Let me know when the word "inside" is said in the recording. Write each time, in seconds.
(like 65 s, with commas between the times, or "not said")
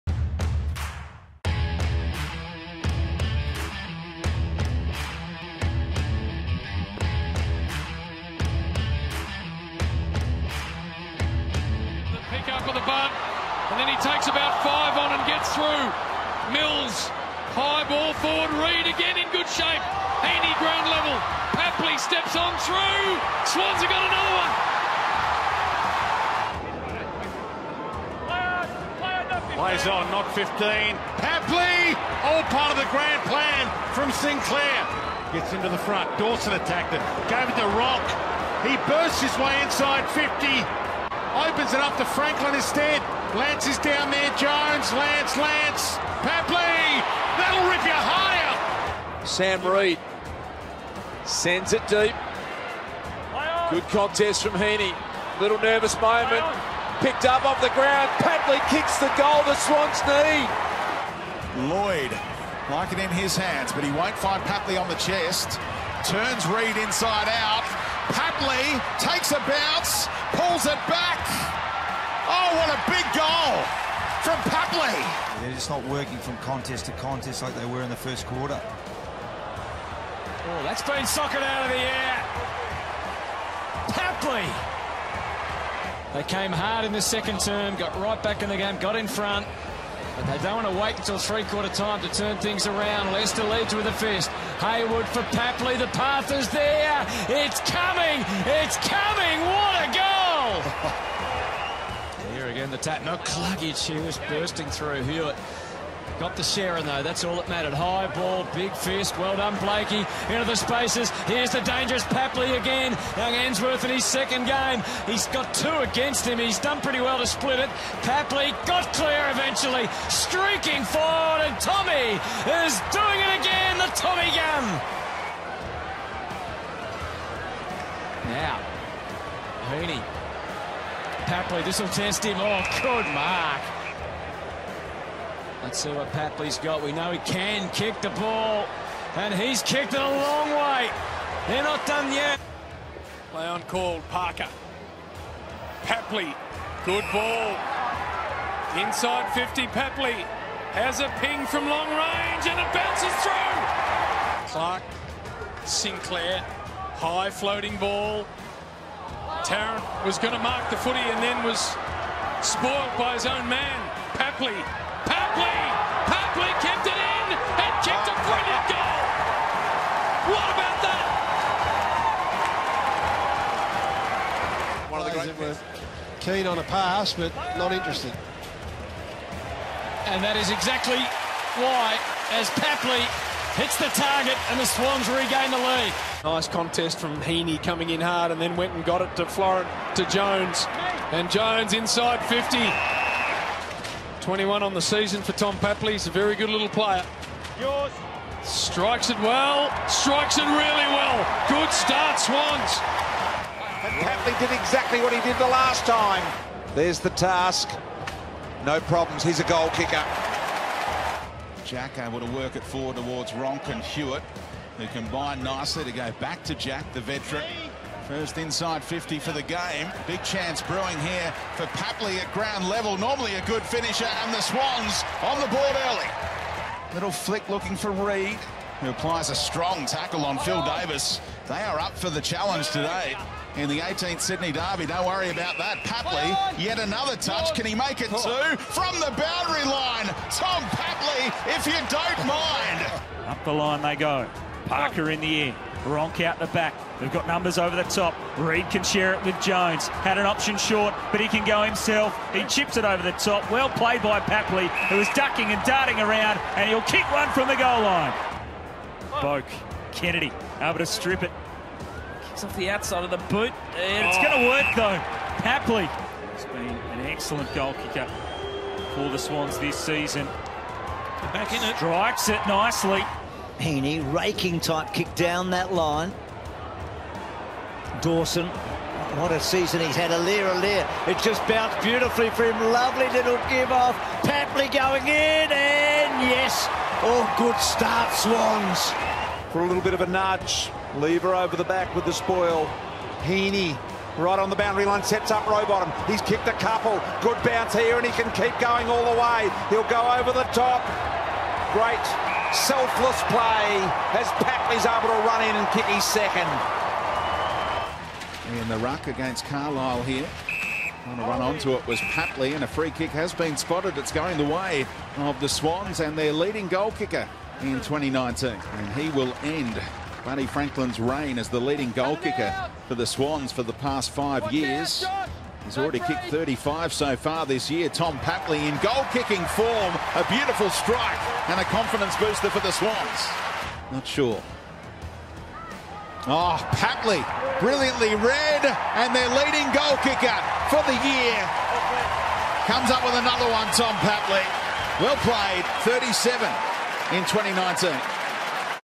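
39 s, 66 s, 148 s, 191 s, 218 s.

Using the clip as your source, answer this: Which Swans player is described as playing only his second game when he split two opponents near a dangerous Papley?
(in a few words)
Ensworth.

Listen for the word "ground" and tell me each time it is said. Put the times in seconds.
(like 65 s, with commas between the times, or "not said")
20 s, 57 s, 222 s.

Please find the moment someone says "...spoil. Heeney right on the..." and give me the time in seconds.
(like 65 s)
292 s.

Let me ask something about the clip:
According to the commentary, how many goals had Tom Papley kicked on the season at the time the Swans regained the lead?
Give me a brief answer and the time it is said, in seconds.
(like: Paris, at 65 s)
21, at 194 s.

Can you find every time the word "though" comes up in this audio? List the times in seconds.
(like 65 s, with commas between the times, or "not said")
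106 s, 264 s.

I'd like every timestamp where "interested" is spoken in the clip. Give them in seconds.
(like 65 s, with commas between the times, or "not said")
177 s.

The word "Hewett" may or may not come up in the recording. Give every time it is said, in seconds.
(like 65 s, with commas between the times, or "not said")
105 s, 213 s.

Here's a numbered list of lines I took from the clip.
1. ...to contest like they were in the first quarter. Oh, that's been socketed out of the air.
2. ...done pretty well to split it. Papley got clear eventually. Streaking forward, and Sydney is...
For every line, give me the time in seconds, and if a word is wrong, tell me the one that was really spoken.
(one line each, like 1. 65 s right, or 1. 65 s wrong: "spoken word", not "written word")
1. 76 s right
2. 116 s wrong: "Tommy", not "Sydney".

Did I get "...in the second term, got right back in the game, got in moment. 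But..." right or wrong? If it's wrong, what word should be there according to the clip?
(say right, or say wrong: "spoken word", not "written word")
wrong: "front", not "moment".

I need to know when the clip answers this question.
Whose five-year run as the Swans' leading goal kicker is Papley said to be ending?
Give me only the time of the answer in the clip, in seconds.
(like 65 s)
320 s.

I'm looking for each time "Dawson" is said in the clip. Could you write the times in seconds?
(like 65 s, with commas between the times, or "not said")
36 s, 278 s.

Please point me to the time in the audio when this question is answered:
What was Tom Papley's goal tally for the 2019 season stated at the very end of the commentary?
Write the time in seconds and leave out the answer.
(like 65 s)
345 s.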